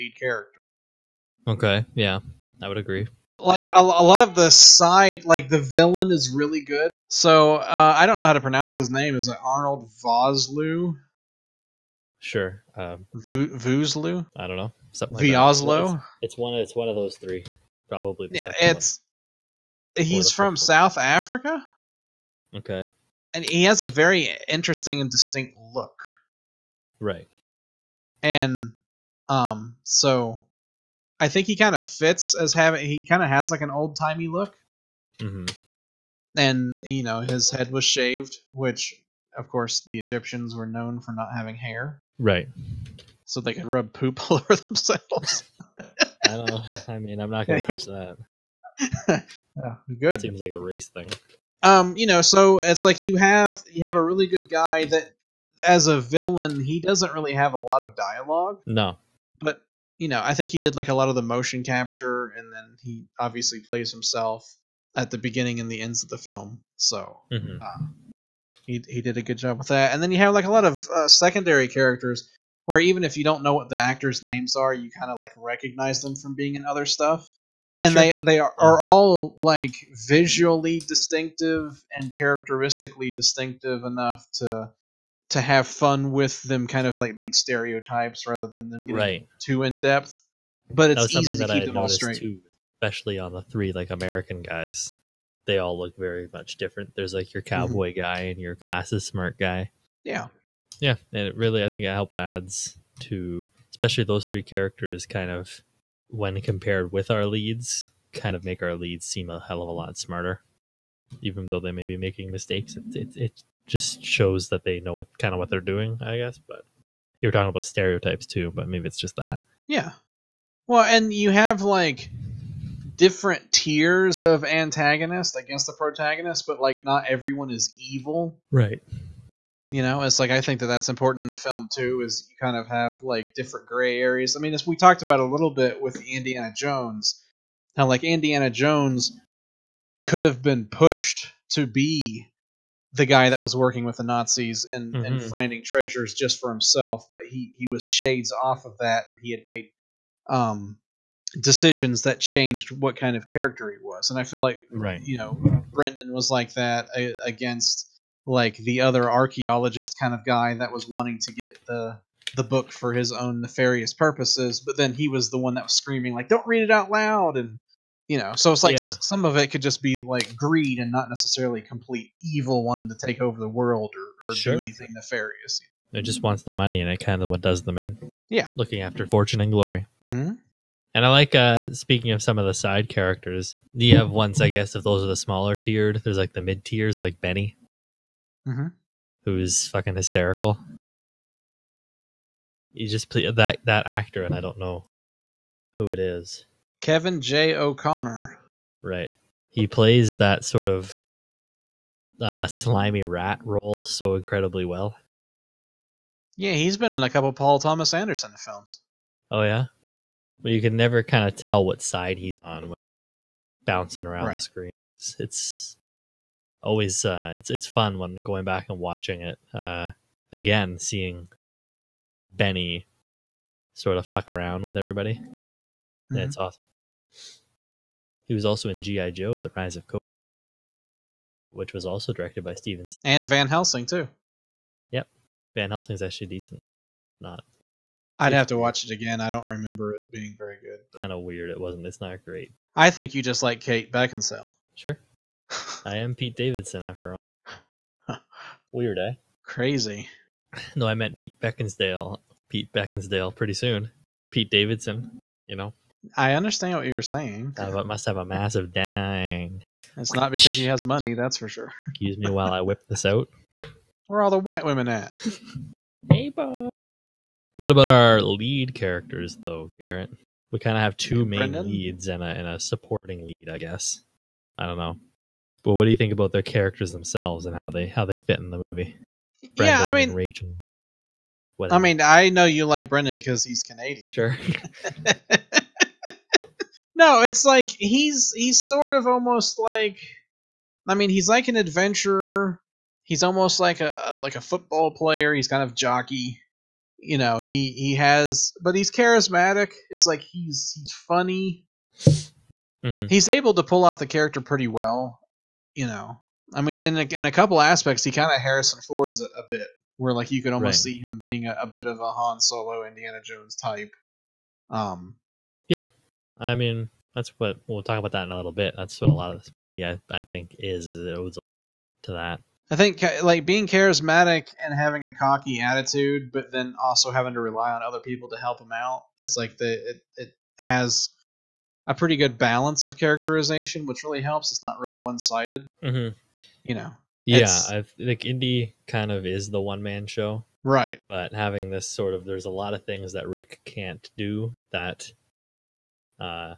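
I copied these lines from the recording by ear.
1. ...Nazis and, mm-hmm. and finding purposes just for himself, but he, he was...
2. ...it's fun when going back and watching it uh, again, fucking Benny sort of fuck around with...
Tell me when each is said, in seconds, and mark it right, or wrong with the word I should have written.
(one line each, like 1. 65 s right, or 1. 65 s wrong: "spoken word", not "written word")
1. 144 s wrong: "treasures", not "purposes"
2. 217 s wrong: "seeing", not "fucking".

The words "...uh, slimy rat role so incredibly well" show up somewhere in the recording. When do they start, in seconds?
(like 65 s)
202 s.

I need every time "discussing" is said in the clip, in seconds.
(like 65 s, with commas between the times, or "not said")
not said.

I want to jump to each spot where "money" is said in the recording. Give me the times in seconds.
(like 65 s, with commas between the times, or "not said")
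176 s, 260 s.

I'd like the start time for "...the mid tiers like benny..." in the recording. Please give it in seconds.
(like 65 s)
186 s.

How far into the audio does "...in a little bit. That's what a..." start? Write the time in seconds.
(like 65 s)
318 s.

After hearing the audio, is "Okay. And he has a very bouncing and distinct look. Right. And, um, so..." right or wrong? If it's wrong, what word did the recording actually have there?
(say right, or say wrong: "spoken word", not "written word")
wrong: "interesting", not "bouncing".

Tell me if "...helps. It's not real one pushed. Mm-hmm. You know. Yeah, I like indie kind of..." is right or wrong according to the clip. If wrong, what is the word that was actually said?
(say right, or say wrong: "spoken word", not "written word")
wrong: "sided", not "pushed".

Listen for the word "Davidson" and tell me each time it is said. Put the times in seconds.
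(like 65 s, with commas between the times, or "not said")
246 s, 254 s.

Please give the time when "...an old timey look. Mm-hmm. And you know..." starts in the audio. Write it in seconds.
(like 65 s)
33 s.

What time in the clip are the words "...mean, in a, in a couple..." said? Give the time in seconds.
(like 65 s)
306 s.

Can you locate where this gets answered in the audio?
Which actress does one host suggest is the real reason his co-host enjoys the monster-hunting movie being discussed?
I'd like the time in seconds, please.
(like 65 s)
243 s.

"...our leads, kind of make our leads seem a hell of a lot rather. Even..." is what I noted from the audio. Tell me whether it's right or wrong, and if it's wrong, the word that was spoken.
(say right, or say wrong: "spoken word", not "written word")
wrong: "smarter", not "rather".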